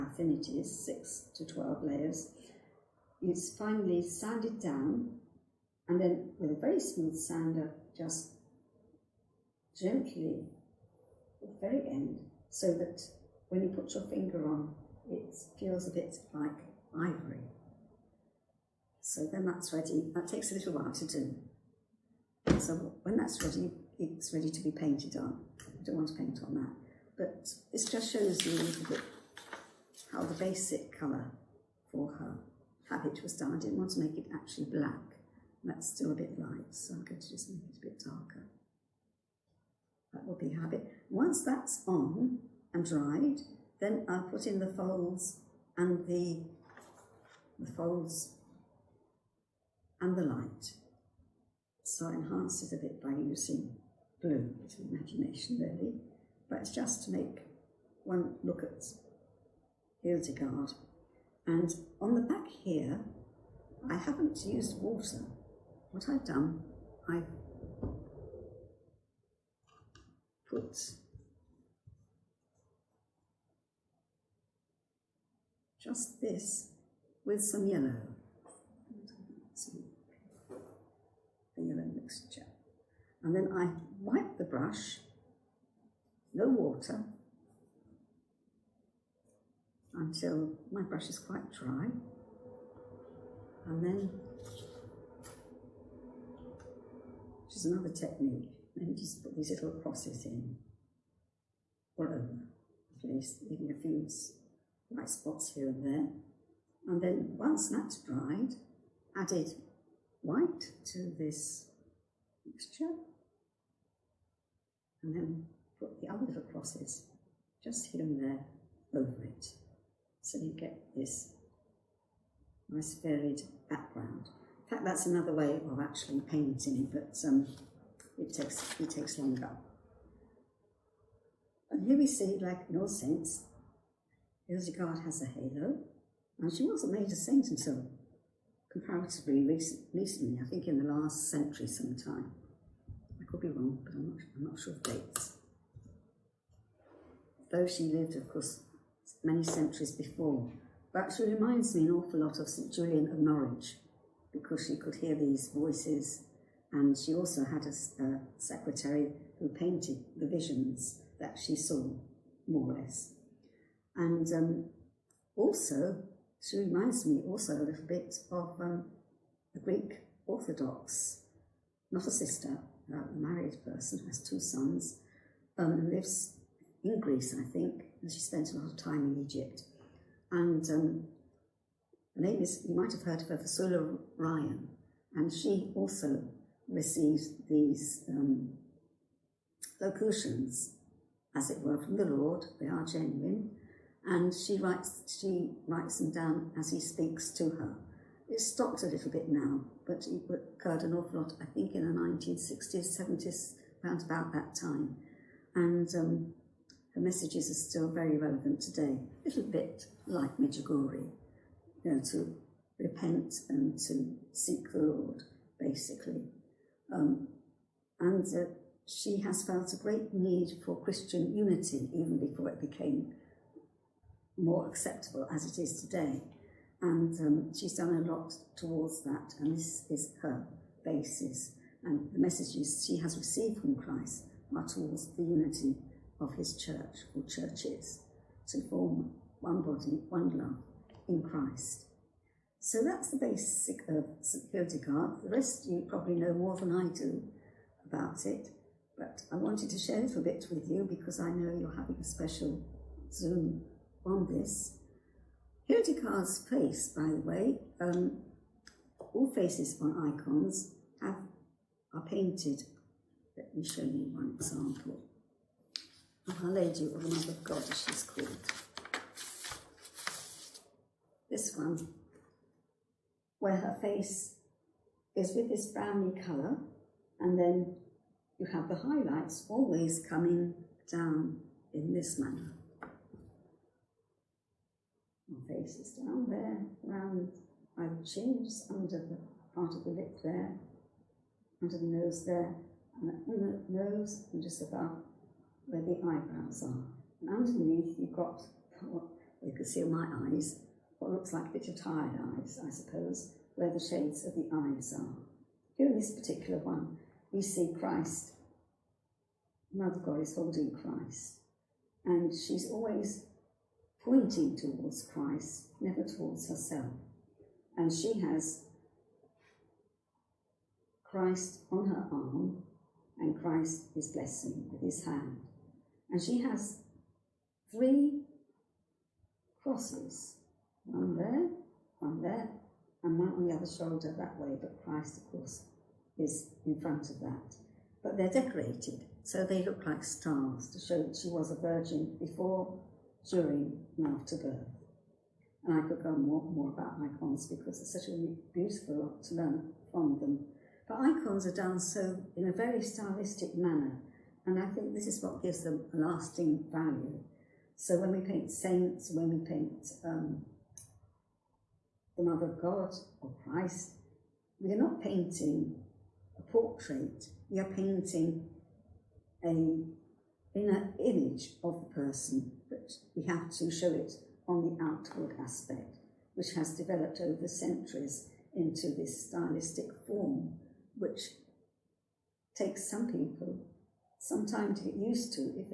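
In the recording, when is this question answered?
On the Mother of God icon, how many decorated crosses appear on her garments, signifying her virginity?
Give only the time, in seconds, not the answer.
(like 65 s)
327 s.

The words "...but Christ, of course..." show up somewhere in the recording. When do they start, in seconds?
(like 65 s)
334 s.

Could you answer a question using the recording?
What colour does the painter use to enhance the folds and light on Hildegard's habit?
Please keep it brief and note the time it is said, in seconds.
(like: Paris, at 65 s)
Blue, at 54 s.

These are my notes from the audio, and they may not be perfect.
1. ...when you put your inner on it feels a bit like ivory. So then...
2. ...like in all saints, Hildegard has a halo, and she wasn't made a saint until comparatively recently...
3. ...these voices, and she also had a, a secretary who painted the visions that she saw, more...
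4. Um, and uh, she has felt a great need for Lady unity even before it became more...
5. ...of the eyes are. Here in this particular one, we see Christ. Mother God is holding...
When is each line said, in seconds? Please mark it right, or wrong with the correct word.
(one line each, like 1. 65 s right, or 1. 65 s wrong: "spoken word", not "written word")
1. 13 s wrong: "finger", not "inner"
2. 132 s right
3. 155 s right
4. 216 s wrong: "Christian", not "Lady"
5. 304 s right.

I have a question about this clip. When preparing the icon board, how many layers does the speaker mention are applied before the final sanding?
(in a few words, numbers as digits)
6 to 12.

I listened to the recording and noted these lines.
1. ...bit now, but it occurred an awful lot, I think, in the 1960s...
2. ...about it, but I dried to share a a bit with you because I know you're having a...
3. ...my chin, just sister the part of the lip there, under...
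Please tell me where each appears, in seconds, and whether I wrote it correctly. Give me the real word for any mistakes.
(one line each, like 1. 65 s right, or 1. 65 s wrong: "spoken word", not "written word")
1. 199 s right
2. 247 s wrong: "wanted", not "dried"
3. 287 s wrong: "under", not "sister".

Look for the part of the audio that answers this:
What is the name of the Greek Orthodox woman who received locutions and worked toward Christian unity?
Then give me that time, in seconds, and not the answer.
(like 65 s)
183 s.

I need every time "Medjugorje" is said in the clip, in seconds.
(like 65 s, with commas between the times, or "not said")
210 s.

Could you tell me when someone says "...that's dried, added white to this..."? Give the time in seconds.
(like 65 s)
107 s.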